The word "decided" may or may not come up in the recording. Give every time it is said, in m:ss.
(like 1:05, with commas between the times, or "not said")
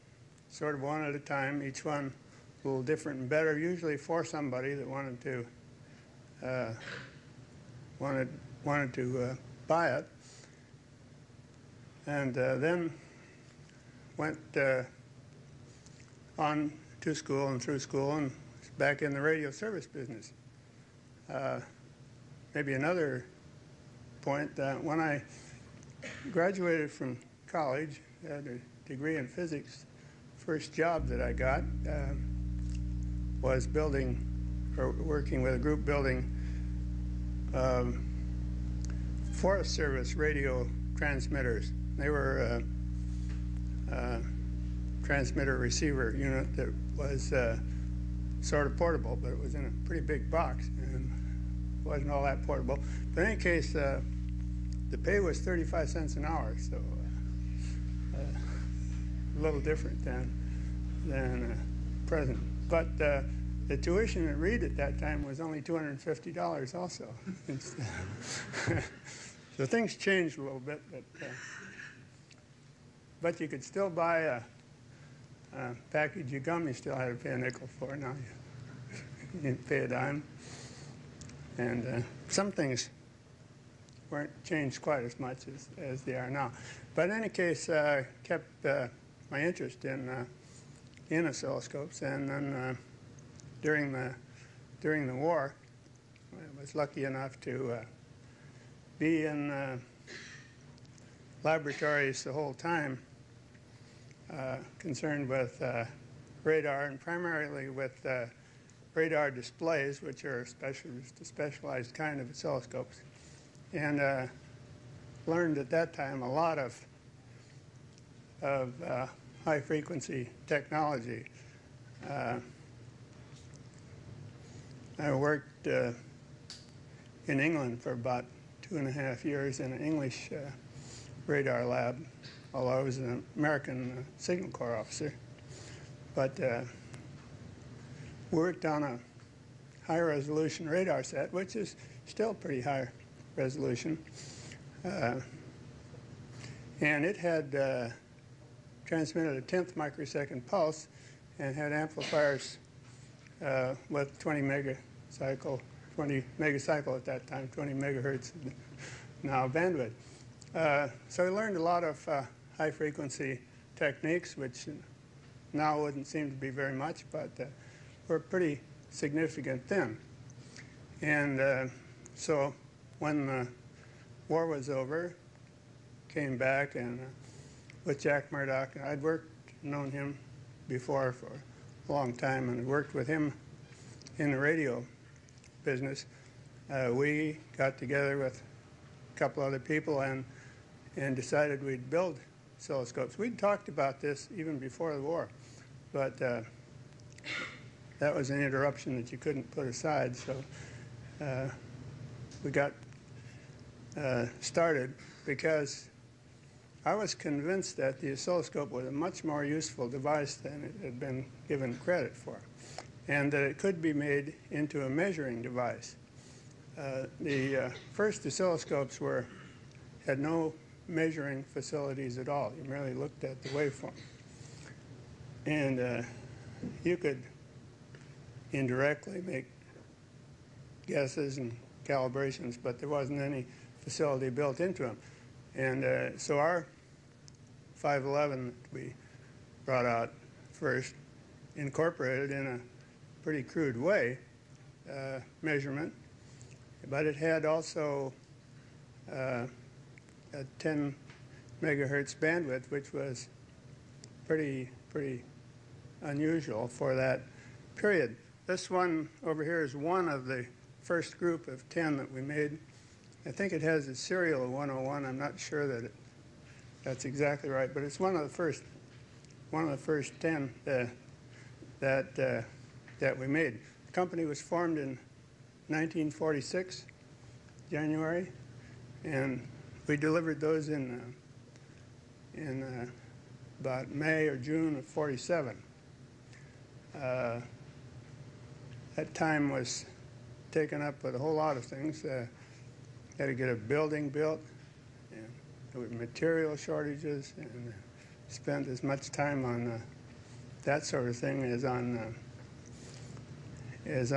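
3:11.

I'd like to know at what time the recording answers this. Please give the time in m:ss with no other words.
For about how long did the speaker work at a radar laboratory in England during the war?
2:08.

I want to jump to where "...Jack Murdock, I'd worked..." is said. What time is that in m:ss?
2:58.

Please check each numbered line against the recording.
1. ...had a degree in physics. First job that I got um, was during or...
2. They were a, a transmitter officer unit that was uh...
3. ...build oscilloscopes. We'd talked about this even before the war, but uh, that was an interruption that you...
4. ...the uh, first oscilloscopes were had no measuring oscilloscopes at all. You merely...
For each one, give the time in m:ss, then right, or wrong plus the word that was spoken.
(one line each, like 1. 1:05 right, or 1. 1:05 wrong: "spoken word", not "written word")
1. 0:28 wrong: "building", not "during"
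2. 0:41 wrong: "receiver", not "officer"
3. 3:11 right
4. 3:37 wrong: "facilities", not "oscilloscopes".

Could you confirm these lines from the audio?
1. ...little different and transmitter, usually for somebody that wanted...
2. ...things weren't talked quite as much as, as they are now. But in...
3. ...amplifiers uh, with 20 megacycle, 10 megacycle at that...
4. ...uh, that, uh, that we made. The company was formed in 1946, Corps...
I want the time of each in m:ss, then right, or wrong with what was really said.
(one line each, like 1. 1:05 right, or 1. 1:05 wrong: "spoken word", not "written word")
1. 0:02 wrong: "better", not "transmitter"
2. 1:22 wrong: "changed", not "talked"
3. 2:31 wrong: "20", not "10"
4. 4:30 wrong: "January", not "Corps".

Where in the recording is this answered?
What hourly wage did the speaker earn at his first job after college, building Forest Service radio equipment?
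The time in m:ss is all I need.
0:55.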